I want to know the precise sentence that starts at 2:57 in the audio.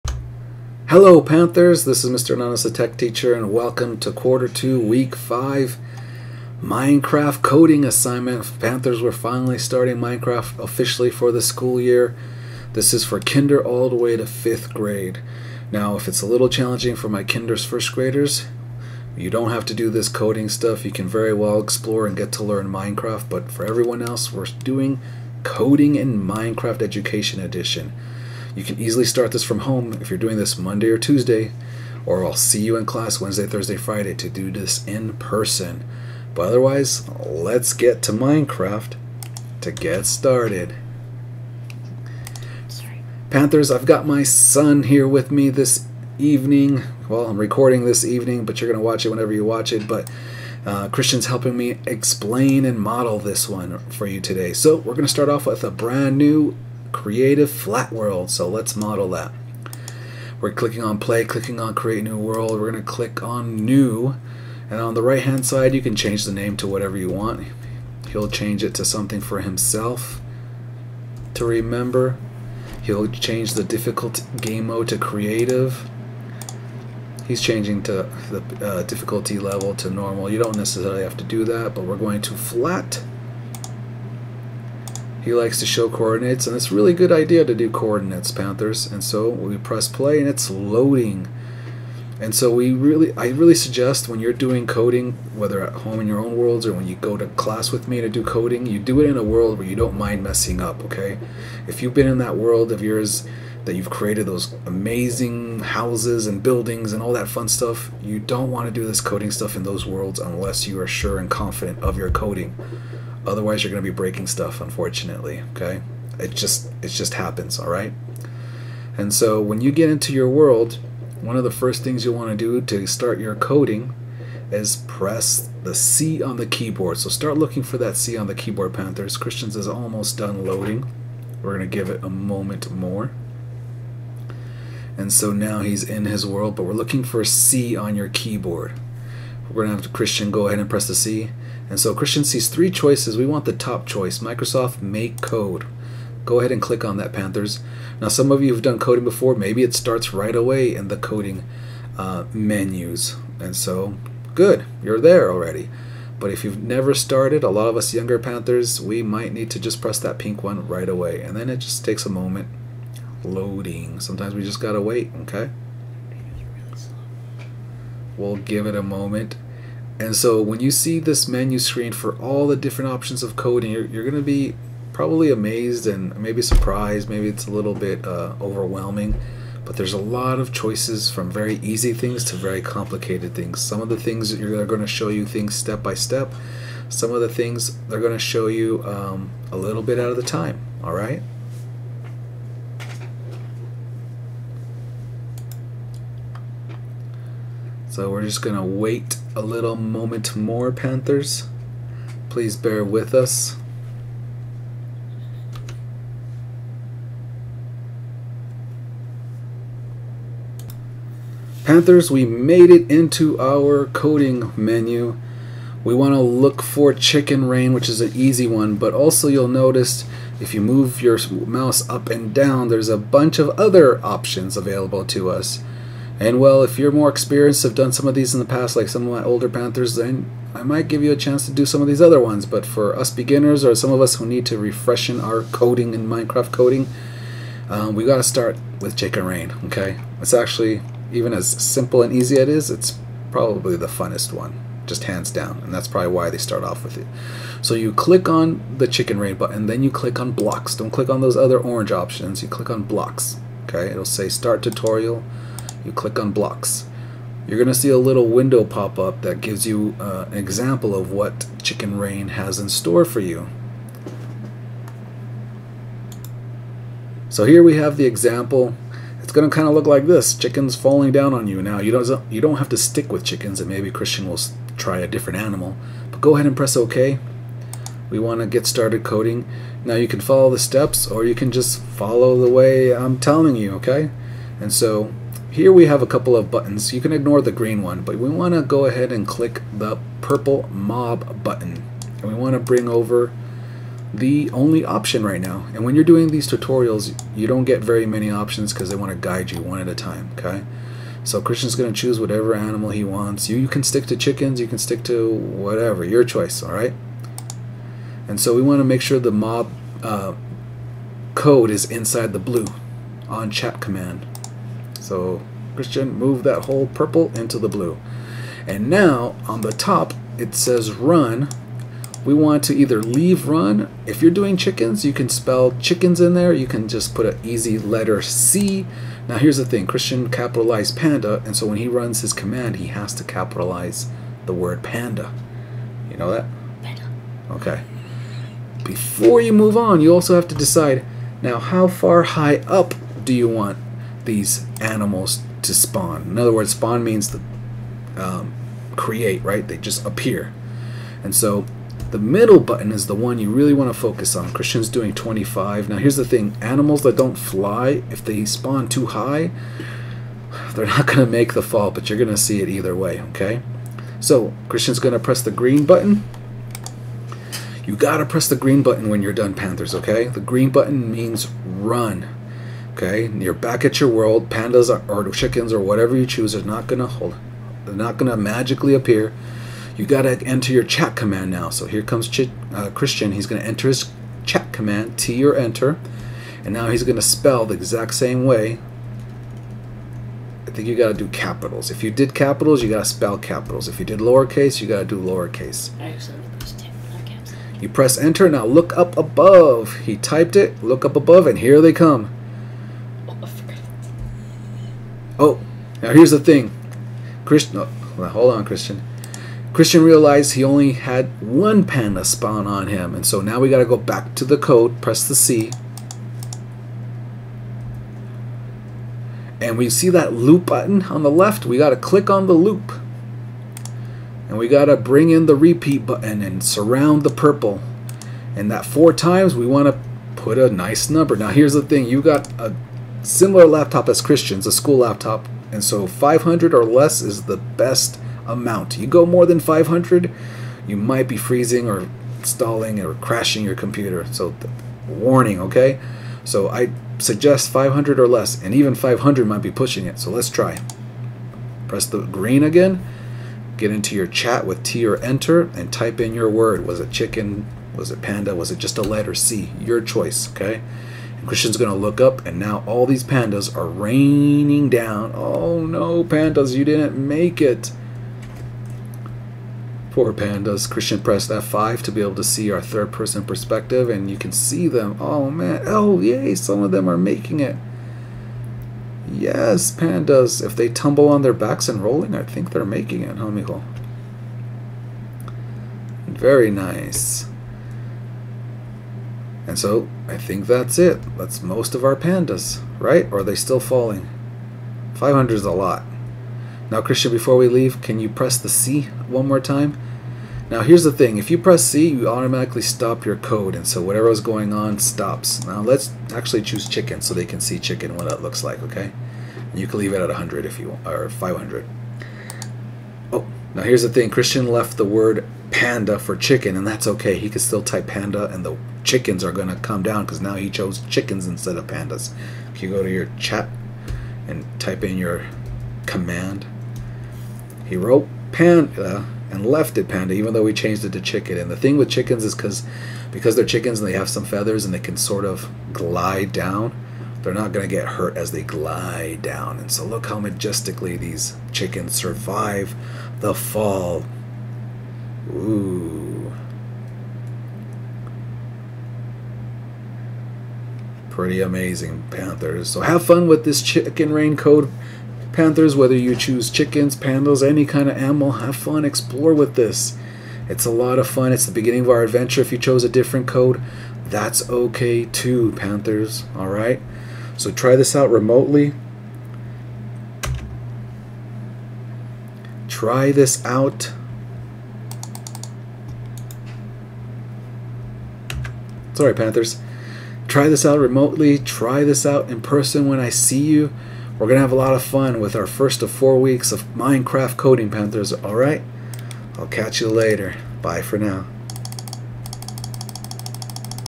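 Maybe it's a little bit uh, overwhelming, but there's a lot of choices from very easy things to very complicated things.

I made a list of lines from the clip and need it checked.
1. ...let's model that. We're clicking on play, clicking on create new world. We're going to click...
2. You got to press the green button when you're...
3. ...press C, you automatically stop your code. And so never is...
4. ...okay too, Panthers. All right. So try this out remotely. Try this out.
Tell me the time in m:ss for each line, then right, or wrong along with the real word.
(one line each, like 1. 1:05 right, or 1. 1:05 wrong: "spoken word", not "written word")
1. 0:58 right
2. 6:07 right
3. 8:21 wrong: "whatever", not "never"
4. 9:24 right.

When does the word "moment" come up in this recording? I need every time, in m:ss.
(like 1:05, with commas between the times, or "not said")
2:12, 2:42, 2:48, 3:19.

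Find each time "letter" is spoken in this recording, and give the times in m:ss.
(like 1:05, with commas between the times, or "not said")
5:27, 7:39.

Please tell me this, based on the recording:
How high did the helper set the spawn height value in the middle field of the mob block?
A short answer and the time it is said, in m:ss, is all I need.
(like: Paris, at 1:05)
25, at 5:55.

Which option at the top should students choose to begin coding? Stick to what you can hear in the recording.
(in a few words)
Microsoft Make Code.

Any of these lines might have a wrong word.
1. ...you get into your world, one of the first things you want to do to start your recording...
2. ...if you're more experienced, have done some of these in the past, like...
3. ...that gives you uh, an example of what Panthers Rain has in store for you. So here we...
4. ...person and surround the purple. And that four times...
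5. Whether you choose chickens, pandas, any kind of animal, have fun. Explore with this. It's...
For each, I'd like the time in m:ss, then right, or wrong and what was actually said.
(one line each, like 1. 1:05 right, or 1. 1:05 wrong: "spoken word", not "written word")
1. 1:59 wrong: "coding", not "recording"
2. 3:46 right
3. 4:19 wrong: "Chicken", not "Panthers"
4. 7:06 wrong: "button", not "person"
5. 9:15 right.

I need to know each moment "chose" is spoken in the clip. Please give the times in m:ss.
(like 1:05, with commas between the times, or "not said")
8:40, 9:22.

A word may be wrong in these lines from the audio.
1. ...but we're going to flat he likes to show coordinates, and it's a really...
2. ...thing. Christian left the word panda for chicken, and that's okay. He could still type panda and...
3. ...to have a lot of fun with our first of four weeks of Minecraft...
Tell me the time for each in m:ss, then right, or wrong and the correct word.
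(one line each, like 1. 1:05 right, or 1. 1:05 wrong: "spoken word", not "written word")
1. 1:21 right
2. 8:34 right
3. 9:44 right.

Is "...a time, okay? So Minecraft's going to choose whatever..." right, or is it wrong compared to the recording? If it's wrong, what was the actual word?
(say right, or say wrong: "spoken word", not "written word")
wrong: "Christian", not "Minecraft".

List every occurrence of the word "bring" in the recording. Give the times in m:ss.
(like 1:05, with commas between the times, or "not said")
4:52, 7:04.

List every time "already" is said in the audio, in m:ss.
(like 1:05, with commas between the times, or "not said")
2:35.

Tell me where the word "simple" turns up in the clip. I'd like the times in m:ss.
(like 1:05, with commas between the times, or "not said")
4:01.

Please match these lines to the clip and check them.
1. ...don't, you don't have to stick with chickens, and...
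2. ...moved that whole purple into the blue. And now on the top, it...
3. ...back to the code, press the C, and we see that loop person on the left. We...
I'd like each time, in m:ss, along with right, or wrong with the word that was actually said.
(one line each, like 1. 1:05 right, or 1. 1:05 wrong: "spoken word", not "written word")
1. 4:31 right
2. 5:16 right
3. 6:53 wrong: "button", not "person".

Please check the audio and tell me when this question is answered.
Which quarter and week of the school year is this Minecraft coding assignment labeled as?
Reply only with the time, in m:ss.
0:04.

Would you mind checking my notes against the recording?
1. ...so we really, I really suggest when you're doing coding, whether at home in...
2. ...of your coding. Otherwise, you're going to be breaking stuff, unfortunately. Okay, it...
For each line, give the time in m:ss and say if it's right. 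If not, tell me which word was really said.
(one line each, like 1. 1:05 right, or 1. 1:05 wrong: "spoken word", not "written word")
1. 1:32 right
2. 1:51 right.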